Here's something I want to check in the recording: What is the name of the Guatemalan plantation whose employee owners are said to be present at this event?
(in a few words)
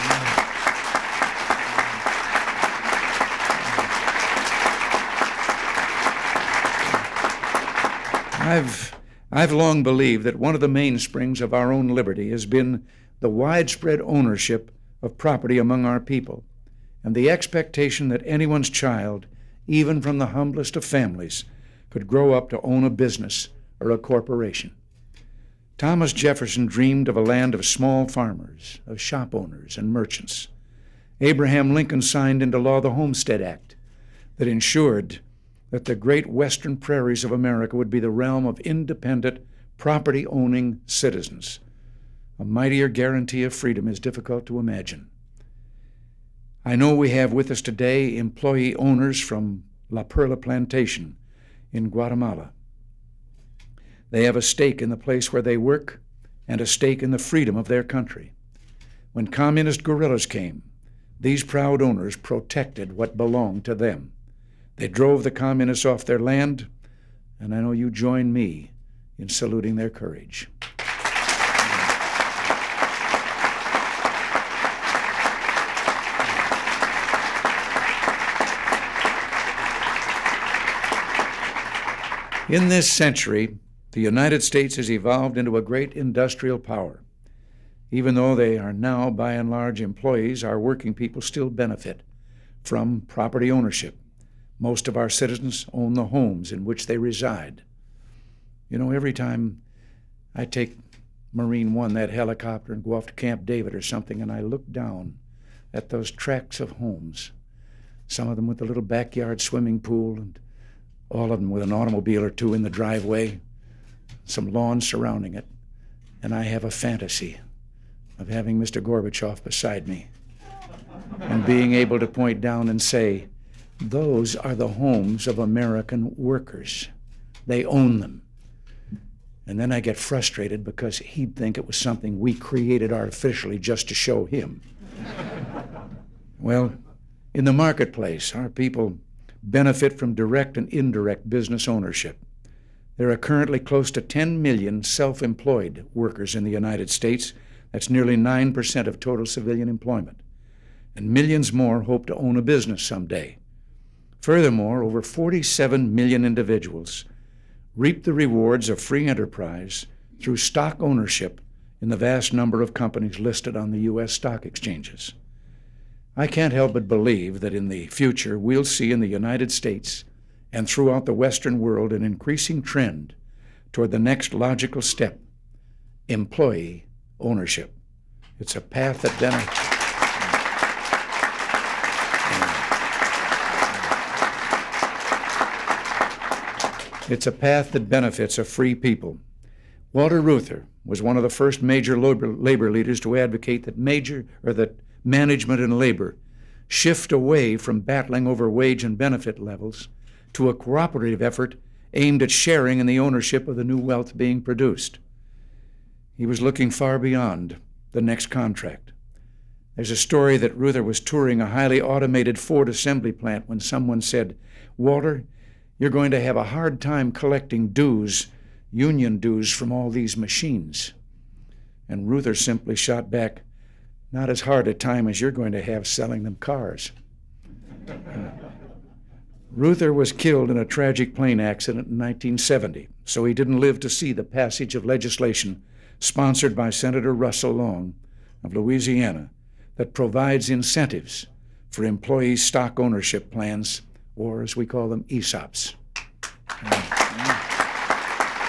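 La Perla Plantation.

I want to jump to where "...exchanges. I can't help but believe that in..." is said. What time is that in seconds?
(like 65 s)
164 s.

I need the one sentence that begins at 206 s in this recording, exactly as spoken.
He was looking far beyond the next contract.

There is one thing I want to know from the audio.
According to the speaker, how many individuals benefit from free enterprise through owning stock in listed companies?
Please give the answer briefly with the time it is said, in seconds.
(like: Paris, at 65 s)
over 47 million, at 154 s.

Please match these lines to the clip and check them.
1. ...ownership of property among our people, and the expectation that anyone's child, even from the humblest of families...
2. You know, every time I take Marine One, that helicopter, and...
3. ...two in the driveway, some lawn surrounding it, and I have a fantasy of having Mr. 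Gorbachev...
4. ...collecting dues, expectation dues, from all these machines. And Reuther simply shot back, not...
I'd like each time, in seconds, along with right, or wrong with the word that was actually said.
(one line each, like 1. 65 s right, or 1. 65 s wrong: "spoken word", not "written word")
1. 14 s right
2. 98 s right
3. 112 s right
4. 217 s wrong: "union", not "expectation".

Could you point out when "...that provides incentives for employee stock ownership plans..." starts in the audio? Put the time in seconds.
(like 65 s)
239 s.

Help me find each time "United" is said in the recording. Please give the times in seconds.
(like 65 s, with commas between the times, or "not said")
83 s, 146 s, 169 s.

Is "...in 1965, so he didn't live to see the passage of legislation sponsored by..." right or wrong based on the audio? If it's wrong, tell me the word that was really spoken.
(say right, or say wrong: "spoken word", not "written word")
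wrong: "1970", not "1965".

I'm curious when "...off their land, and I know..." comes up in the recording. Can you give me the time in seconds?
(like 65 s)
65 s.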